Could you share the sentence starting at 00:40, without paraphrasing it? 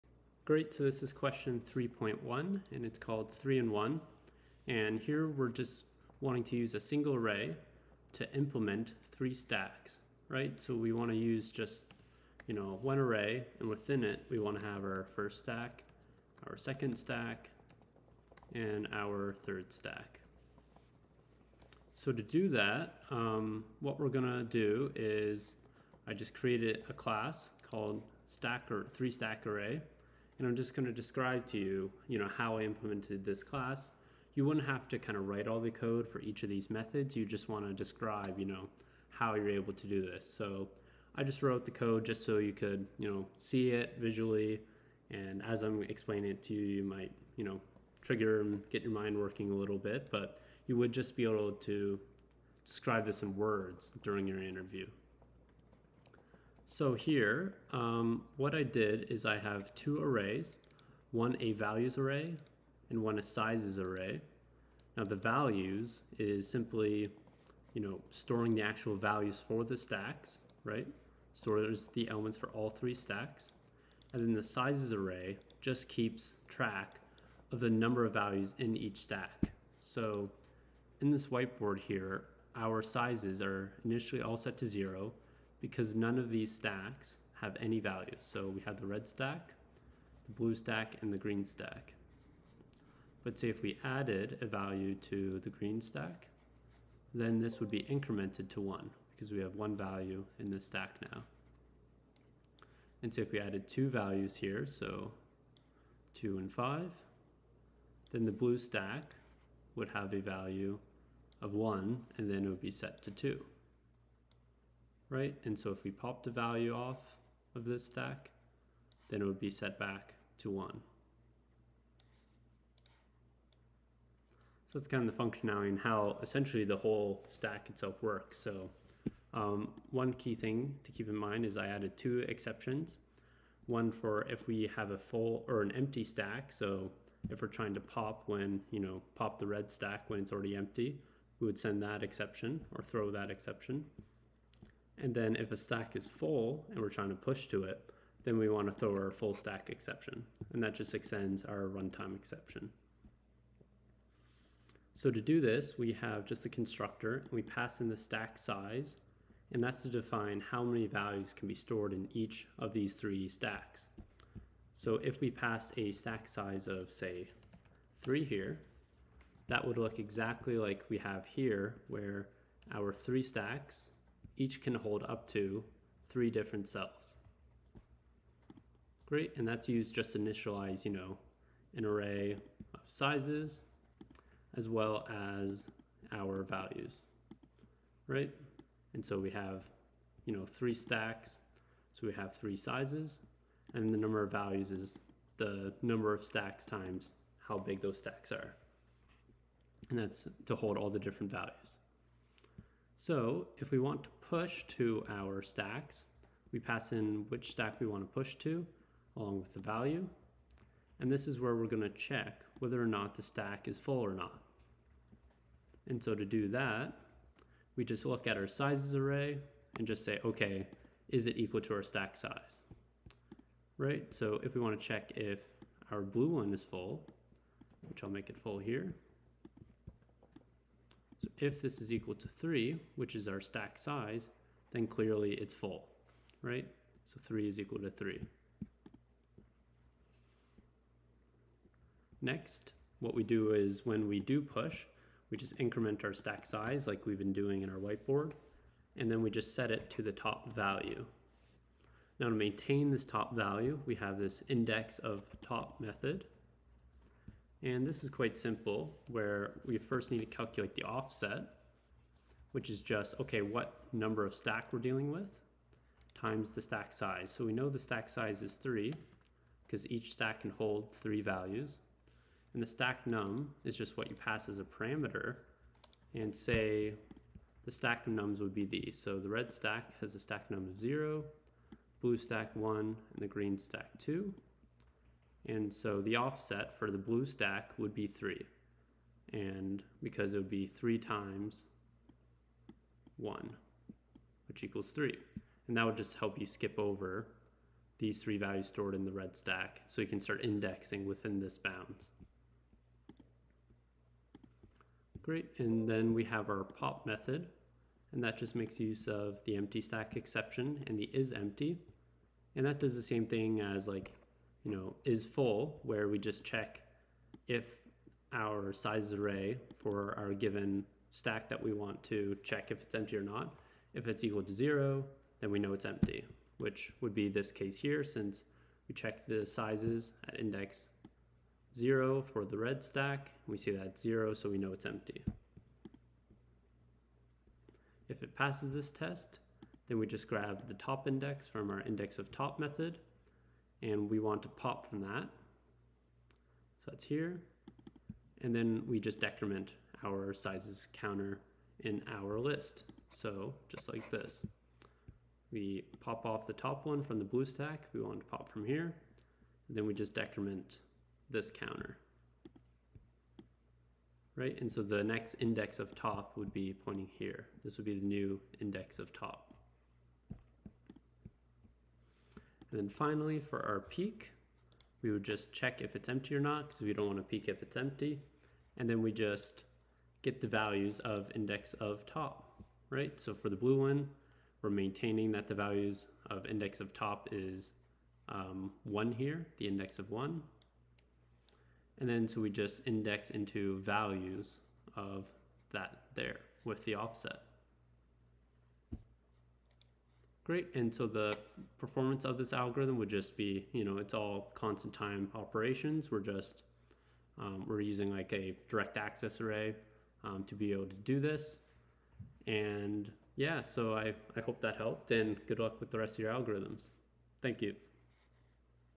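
So I just wrote the code just so you could, you know, see it visually.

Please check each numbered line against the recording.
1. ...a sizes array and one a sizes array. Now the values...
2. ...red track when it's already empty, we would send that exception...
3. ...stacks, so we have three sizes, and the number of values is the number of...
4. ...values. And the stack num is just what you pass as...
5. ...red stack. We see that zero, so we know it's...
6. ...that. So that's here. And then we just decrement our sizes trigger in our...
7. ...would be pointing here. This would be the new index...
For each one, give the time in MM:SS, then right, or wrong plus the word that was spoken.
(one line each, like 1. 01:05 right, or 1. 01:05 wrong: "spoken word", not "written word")
1. 01:01 wrong: "values", not "sizes"
2. 02:19 wrong: "stack", not "track"
3. 03:10 right
4. 04:31 right
5. 05:32 right
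6. 05:45 wrong: "counter", not "trigger"
7. 06:06 right.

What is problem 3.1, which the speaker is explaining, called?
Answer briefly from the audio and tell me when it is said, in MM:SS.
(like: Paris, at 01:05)
3 in 1, at 00:03.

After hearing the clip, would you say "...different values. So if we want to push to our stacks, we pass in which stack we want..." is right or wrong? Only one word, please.
right.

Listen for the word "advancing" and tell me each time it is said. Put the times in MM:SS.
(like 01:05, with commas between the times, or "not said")
not said.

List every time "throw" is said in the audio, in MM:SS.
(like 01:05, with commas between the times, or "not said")
02:22, 02:28.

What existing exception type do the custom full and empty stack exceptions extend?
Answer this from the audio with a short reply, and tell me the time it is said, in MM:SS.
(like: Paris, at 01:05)
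runtime exception, at 02:31.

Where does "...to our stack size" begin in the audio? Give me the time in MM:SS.
03:41.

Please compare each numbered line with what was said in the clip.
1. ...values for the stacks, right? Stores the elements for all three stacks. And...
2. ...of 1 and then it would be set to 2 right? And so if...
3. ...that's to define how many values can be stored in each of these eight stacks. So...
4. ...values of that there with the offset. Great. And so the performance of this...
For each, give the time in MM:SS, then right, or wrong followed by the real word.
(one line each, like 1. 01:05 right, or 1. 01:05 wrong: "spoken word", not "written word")
1. 01:08 right
2. 01:51 right
3. 02:39 wrong: "three", not "eight"
4. 06:33 right.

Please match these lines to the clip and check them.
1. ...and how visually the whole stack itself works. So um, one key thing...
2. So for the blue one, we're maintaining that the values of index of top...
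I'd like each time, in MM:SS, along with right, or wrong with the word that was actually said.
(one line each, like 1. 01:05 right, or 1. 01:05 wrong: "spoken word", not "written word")
1. 02:05 wrong: "essentially", not "visually"
2. 06:23 right.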